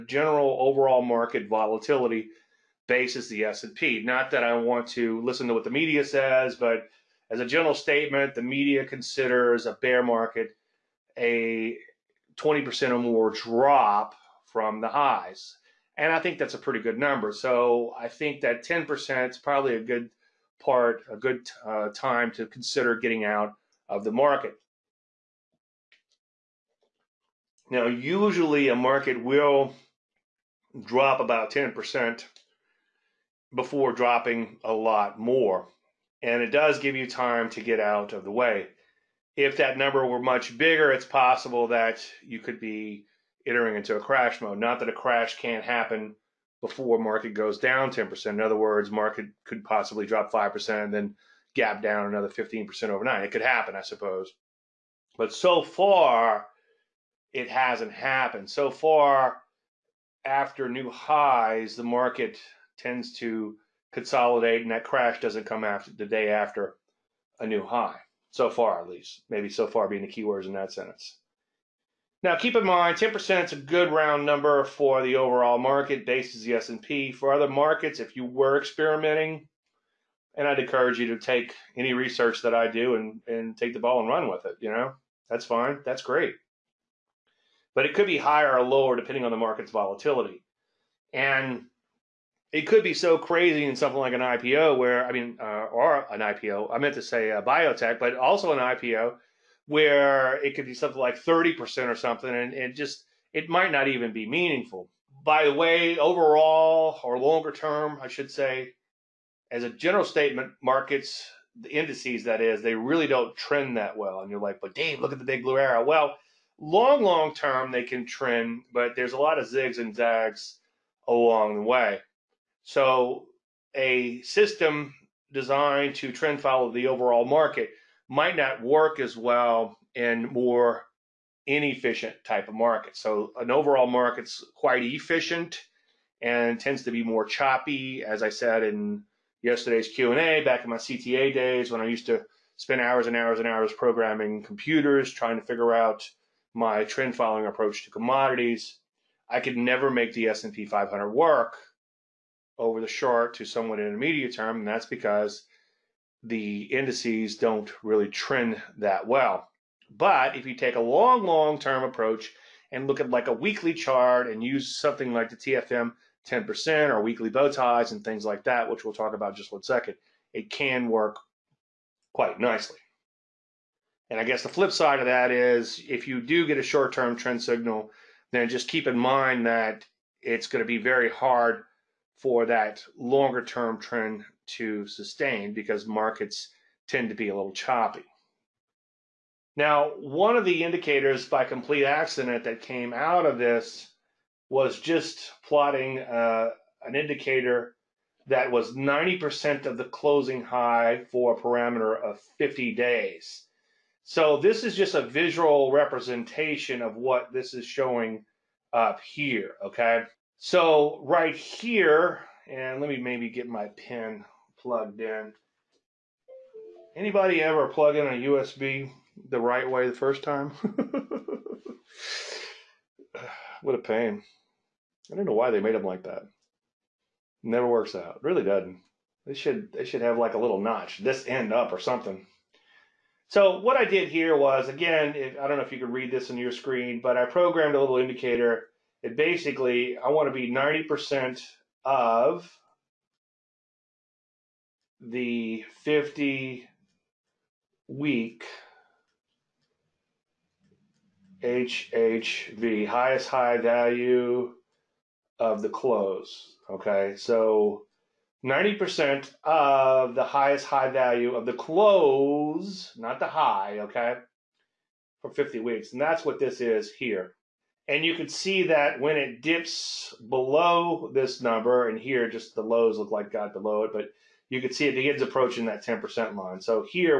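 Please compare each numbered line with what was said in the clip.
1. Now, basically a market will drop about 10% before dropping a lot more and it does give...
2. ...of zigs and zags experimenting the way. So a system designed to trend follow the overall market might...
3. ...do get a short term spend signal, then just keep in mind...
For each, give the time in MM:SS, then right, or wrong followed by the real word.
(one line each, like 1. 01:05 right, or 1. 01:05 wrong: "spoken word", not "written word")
1. 00:27 wrong: "usually", not "basically"
2. 01:59 wrong: "along", not "experimenting"
3. 02:56 wrong: "trend", not "spend".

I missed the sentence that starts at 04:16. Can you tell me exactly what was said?
Okay, so 90% of the highest high value of the close, not the high, okay, for 50 weeks.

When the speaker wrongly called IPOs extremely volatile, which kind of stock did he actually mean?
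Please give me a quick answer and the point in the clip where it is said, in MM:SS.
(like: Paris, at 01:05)
Biotech, at 01:37.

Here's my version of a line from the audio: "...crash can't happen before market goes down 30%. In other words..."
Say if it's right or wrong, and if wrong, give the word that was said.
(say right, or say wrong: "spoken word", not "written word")
wrong: "10", not "30".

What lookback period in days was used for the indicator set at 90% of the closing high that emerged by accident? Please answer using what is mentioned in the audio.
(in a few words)
50 days.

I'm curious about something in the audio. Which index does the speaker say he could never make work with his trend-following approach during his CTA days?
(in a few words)
S&P 500.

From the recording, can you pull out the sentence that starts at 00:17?
So I think that 10% is probably a good part, a good uh, time to consider getting out of the market.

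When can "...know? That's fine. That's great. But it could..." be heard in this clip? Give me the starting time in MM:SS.
01:24.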